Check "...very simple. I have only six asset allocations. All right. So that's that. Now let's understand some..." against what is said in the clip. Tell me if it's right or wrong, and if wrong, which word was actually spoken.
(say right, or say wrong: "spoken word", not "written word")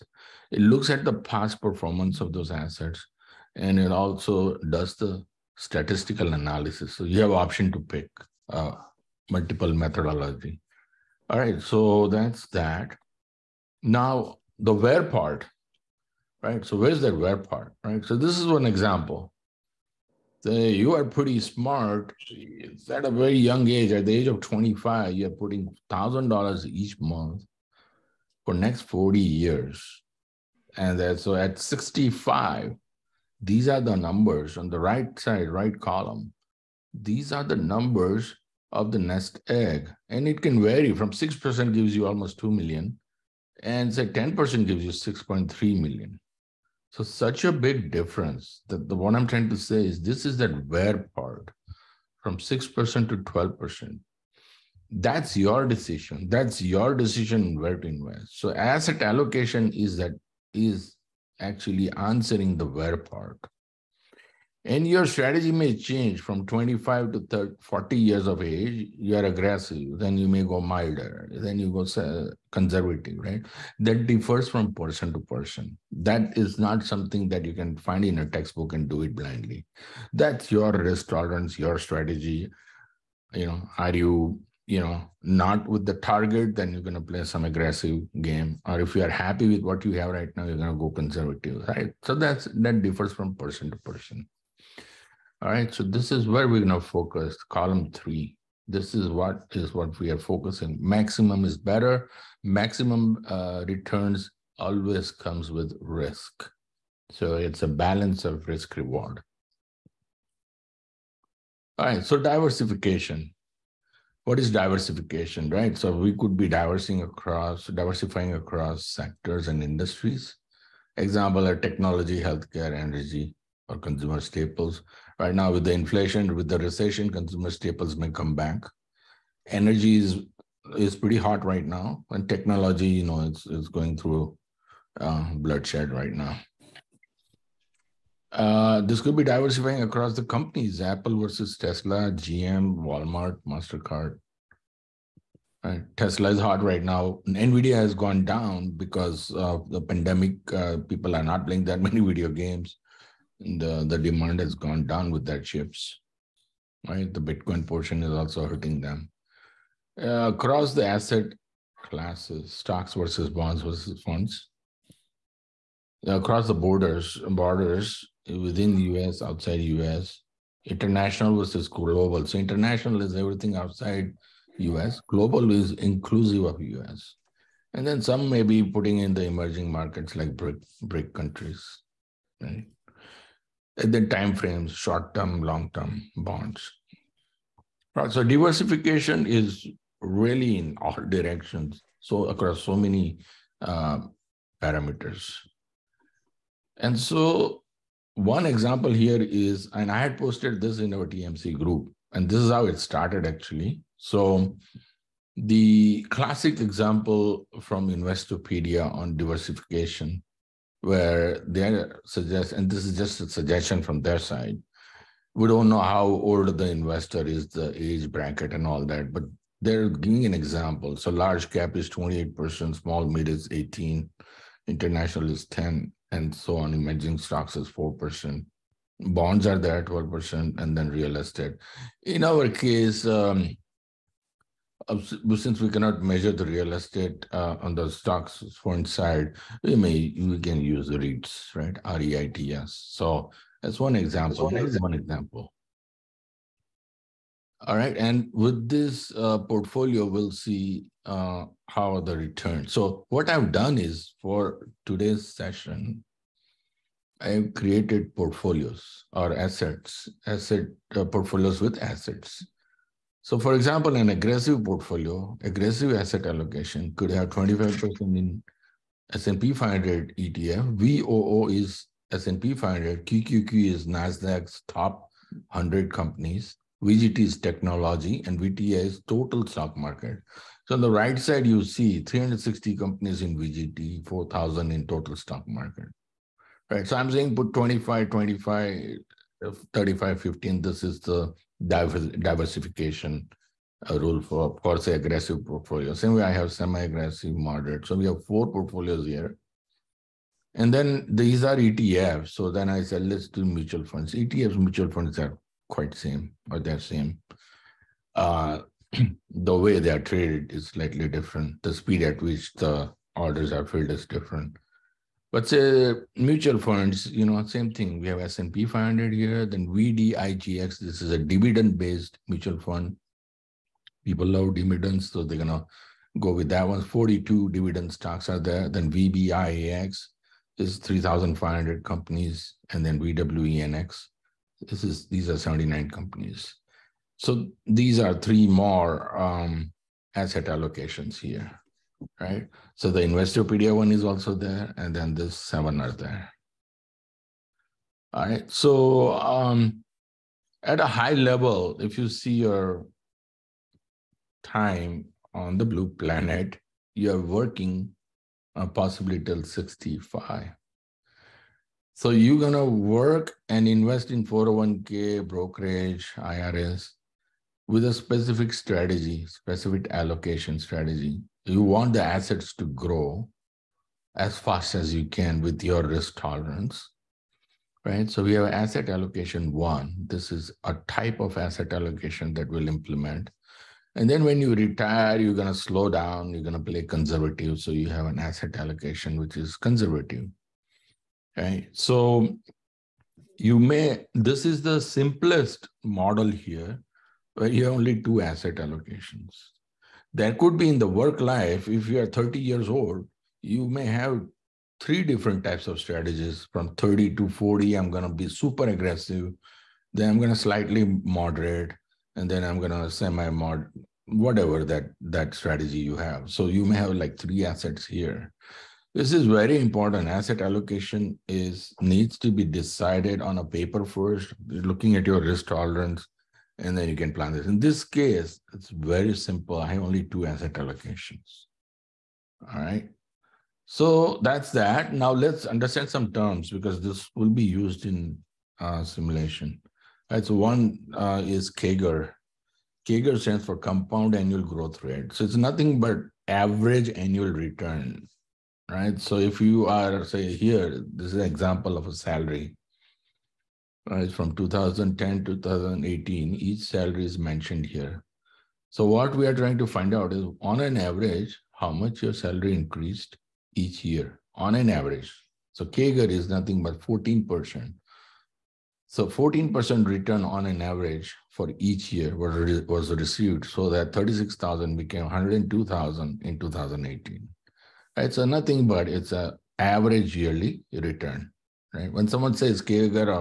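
wrong: "two", not "six".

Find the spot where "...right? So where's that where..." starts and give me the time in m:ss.
0:16.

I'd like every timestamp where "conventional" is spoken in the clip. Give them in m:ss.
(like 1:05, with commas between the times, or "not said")
not said.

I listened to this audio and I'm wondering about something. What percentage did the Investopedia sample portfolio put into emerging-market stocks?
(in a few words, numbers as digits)
4%.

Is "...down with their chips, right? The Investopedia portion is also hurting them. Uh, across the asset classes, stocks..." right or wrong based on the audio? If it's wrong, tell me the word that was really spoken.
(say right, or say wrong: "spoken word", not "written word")
wrong: "Bitcoin", not "Investopedia".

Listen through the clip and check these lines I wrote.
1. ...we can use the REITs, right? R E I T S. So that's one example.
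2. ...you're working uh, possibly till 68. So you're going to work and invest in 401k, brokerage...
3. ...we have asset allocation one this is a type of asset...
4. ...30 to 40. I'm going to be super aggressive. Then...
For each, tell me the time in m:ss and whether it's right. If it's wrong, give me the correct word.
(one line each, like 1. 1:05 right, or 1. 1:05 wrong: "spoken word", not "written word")
1. 4:00 right
2. 5:56 wrong: "65", not "68"
3. 6:18 right
4. 6:46 right.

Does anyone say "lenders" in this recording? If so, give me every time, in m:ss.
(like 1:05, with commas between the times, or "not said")
not said.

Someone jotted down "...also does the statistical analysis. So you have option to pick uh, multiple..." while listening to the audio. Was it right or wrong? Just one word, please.
right.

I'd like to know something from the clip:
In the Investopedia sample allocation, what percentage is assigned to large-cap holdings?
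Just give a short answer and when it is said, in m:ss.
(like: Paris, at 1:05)
28%, at 3:41.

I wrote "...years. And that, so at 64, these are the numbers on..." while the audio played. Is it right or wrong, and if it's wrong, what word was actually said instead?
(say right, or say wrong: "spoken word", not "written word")
wrong: "65", not "64".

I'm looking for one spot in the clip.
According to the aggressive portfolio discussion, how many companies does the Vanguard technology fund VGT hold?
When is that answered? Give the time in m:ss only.
4:42.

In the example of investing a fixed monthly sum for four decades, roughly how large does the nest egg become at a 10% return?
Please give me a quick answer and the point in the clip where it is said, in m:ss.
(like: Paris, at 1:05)
6.3 million, at 0:45.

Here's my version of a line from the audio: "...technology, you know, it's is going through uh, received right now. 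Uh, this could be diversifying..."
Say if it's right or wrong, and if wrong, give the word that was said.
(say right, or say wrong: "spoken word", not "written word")
wrong: "bloodshed", not "received".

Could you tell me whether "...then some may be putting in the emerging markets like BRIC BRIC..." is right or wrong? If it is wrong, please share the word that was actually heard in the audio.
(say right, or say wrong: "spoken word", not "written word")
right.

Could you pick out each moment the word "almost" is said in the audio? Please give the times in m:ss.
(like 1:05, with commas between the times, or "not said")
0:42.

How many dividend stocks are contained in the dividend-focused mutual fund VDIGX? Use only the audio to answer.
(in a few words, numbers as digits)
42.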